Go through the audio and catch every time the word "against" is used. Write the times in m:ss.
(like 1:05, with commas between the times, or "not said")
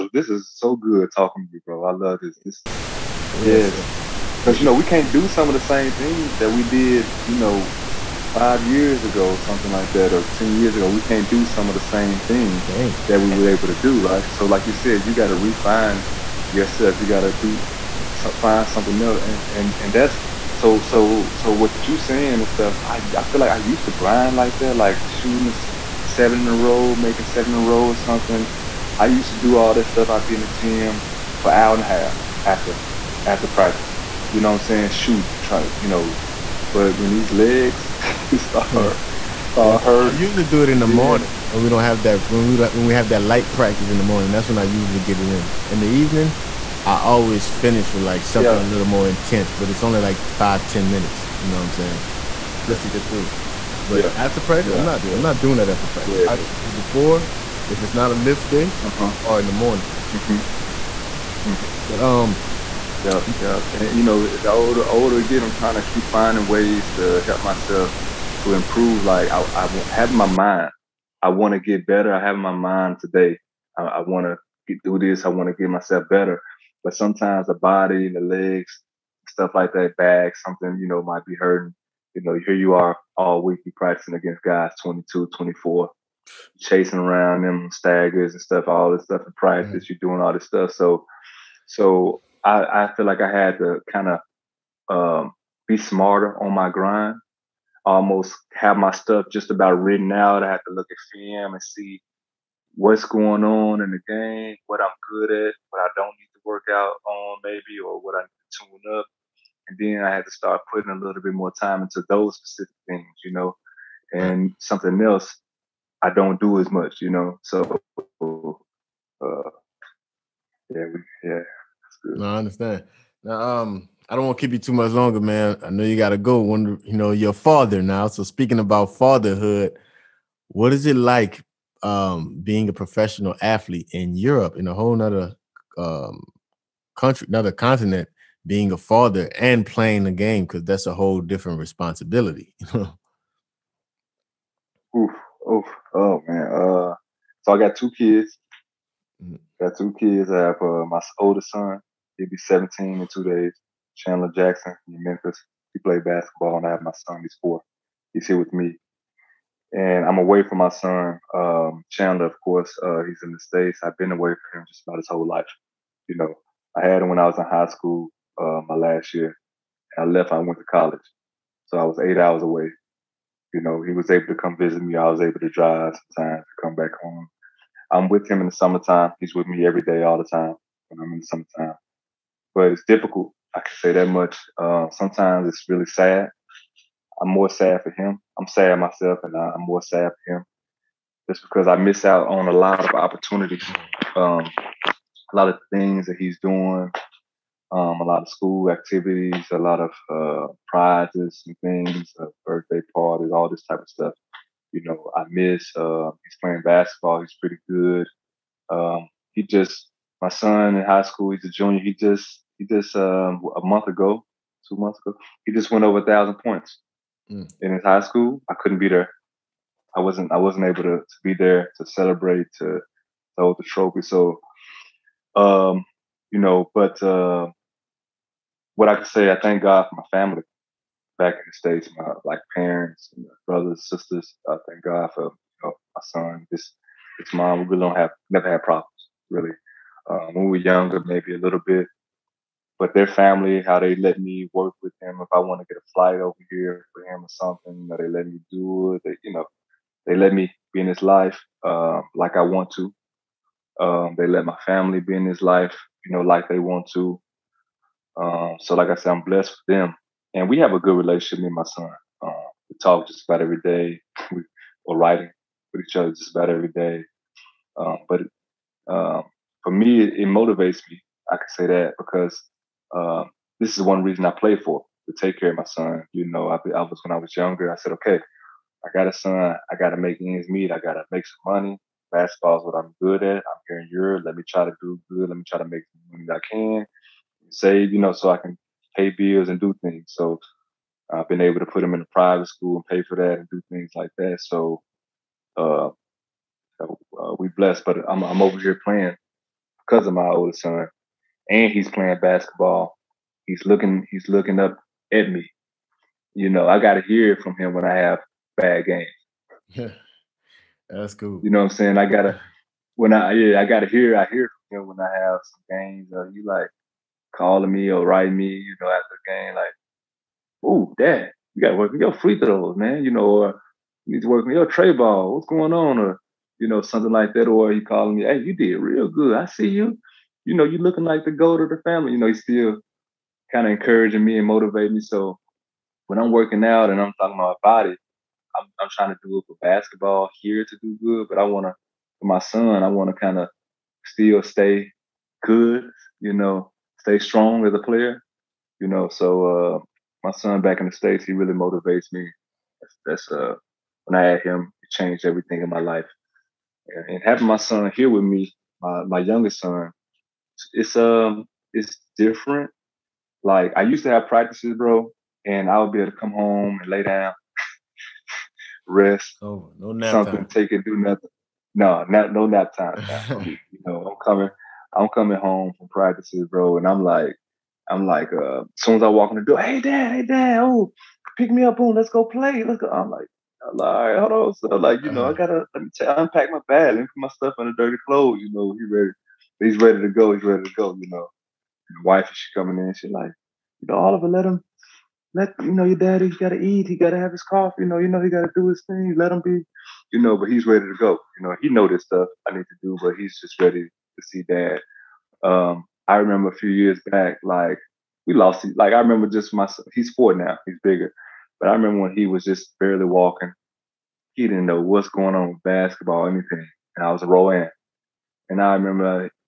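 1:24.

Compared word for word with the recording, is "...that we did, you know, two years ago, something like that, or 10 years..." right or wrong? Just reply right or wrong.
wrong.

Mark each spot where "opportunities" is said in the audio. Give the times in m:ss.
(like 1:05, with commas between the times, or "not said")
3:12.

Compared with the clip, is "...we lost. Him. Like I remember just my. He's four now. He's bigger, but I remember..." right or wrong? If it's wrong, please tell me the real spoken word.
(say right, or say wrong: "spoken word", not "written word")
right.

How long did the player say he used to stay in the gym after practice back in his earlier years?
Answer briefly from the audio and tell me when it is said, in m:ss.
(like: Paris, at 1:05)
An hour and a half, at 0:31.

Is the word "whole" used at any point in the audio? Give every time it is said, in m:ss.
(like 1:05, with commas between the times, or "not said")
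2:14, 2:20, 2:45.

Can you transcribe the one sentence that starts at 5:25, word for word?
Or, you know, something like that.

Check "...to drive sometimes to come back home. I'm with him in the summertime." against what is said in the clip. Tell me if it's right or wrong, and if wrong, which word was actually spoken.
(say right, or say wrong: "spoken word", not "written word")
right.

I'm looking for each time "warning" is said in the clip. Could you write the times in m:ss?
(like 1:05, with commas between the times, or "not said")
not said.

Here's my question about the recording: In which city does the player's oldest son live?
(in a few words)
Memphis.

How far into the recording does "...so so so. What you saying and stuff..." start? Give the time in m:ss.
0:20.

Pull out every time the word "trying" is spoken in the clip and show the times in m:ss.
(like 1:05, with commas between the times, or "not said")
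1:05, 5:38.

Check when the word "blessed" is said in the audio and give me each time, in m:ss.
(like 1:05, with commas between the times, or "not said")
4:19, 4:57.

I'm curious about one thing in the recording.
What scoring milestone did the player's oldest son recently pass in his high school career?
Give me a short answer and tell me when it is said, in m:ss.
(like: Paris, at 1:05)
1000 points, at 3:35.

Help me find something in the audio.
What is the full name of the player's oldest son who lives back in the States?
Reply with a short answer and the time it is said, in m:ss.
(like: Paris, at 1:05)
Chandler Jackson, at 2:33.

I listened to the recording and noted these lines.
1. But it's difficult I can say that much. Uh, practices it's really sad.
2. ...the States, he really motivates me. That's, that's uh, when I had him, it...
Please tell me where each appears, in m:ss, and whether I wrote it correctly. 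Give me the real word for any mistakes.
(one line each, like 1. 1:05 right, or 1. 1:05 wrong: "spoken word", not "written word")
1. 3:02 wrong: "sometimes", not "practices"
2. 5:50 right.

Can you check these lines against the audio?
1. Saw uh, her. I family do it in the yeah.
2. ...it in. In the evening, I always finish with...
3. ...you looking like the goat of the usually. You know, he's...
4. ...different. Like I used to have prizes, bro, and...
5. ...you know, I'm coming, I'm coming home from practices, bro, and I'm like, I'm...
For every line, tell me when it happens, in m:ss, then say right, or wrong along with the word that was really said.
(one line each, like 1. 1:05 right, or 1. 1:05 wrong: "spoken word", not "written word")
1. 0:39 wrong: "usually", not "family"
2. 0:45 right
3. 5:30 wrong: "family", not "usually"
4. 6:02 wrong: "practices", not "prizes"
5. 6:13 right.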